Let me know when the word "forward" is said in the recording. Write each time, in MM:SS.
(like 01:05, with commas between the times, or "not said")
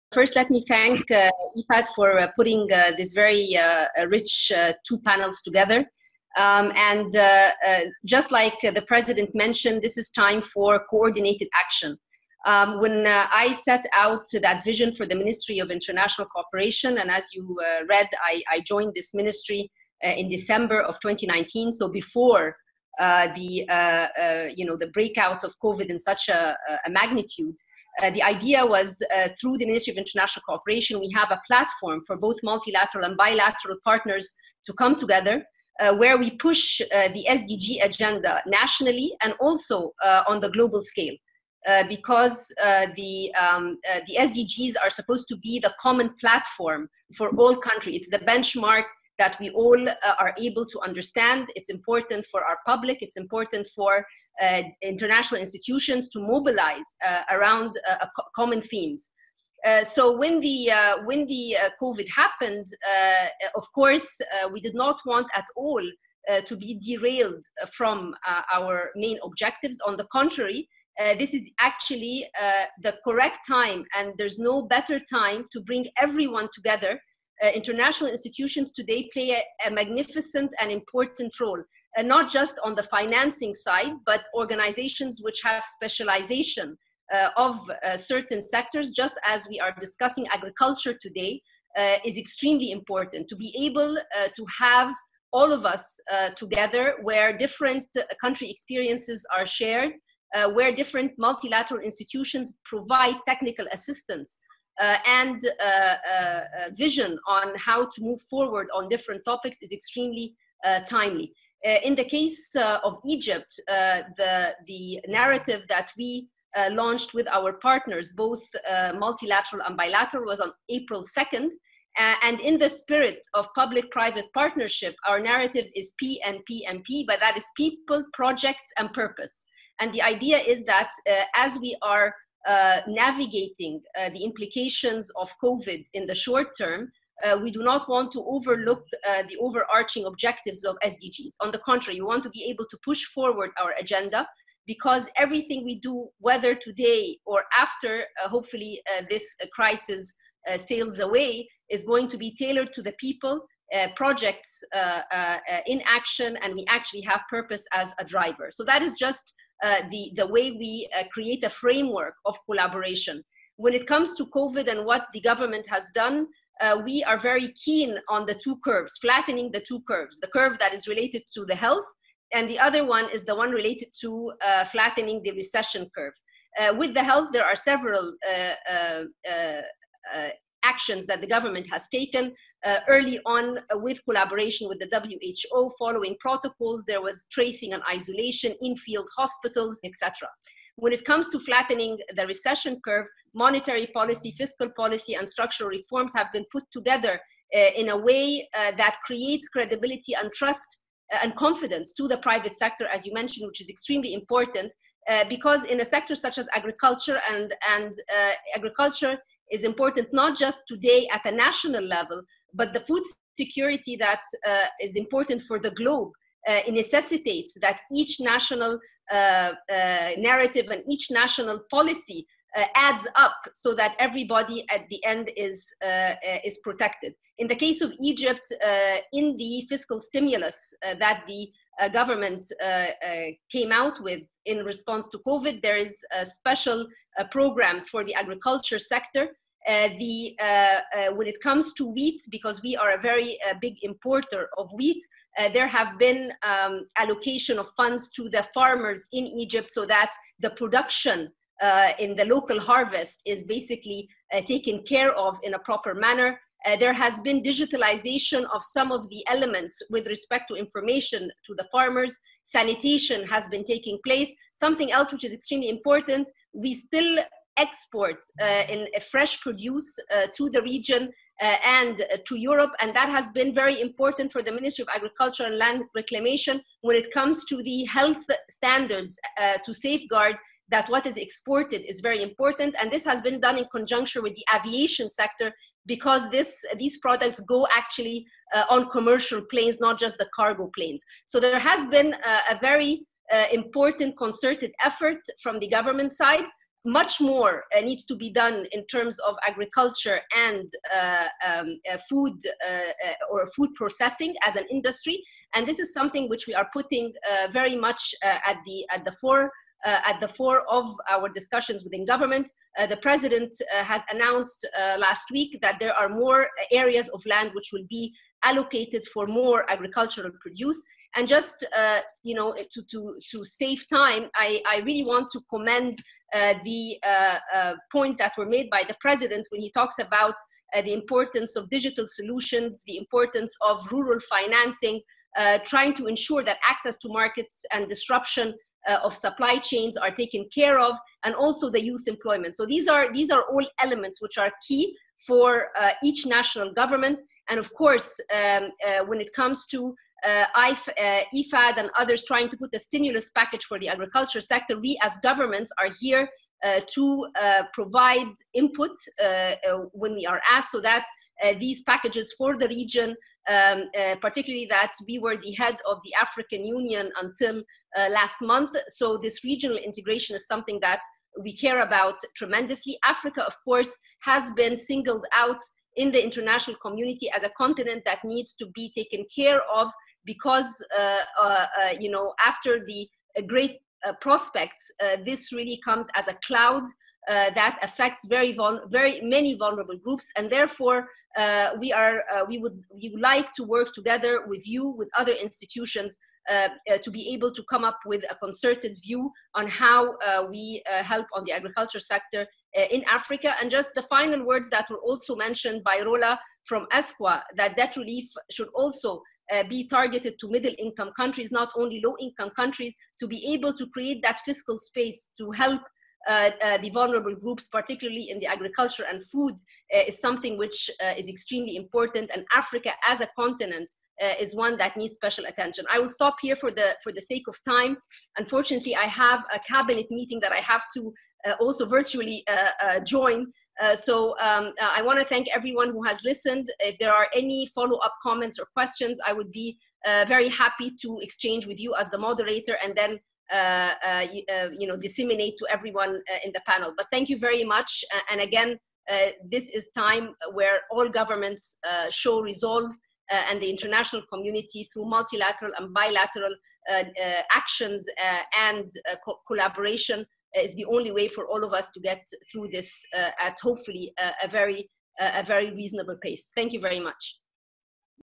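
01:48, 02:23.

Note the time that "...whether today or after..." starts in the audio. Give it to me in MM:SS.
02:26.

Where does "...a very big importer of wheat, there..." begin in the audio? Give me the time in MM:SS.
04:02.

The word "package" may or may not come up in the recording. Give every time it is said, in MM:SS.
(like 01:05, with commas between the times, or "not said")
05:53, 06:01.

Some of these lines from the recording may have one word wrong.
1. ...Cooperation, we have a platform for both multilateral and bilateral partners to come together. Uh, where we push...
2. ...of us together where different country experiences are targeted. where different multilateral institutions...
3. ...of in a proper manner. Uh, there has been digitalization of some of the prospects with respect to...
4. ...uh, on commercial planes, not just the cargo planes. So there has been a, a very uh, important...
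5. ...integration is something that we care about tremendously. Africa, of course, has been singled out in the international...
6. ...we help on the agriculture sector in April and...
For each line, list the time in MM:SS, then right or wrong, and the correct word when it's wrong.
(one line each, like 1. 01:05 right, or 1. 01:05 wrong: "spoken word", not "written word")
1. 00:30 right
2. 01:35 wrong: "shared", not "targeted"
3. 04:15 wrong: "elements", not "prospects"
4. 04:48 right
5. 06:09 right
6. 06:40 wrong: "Africa", not "April".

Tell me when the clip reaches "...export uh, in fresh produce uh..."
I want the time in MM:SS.
04:27.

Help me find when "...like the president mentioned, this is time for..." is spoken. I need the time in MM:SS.
00:08.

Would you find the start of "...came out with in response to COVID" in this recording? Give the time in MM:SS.
03:53.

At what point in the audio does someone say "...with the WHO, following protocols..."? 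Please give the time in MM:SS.
03:04.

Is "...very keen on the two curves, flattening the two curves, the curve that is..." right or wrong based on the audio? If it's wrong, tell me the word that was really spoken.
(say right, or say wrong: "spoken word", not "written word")
right.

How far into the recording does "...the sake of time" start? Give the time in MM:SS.
07:07.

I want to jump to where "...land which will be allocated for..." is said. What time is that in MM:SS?
05:17.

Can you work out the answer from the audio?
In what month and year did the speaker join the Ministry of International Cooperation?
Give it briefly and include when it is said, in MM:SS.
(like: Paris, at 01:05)
December 2019, at 00:20.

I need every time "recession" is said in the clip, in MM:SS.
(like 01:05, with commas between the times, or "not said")
02:55, 03:12.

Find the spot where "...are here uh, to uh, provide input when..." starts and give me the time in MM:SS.
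05:55.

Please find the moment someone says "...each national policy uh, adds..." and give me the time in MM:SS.
03:40.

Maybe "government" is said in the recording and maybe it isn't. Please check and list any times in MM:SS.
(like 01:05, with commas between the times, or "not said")
02:45, 03:01, 03:51, 04:55, 05:12, 05:46, 05:55, 07:31.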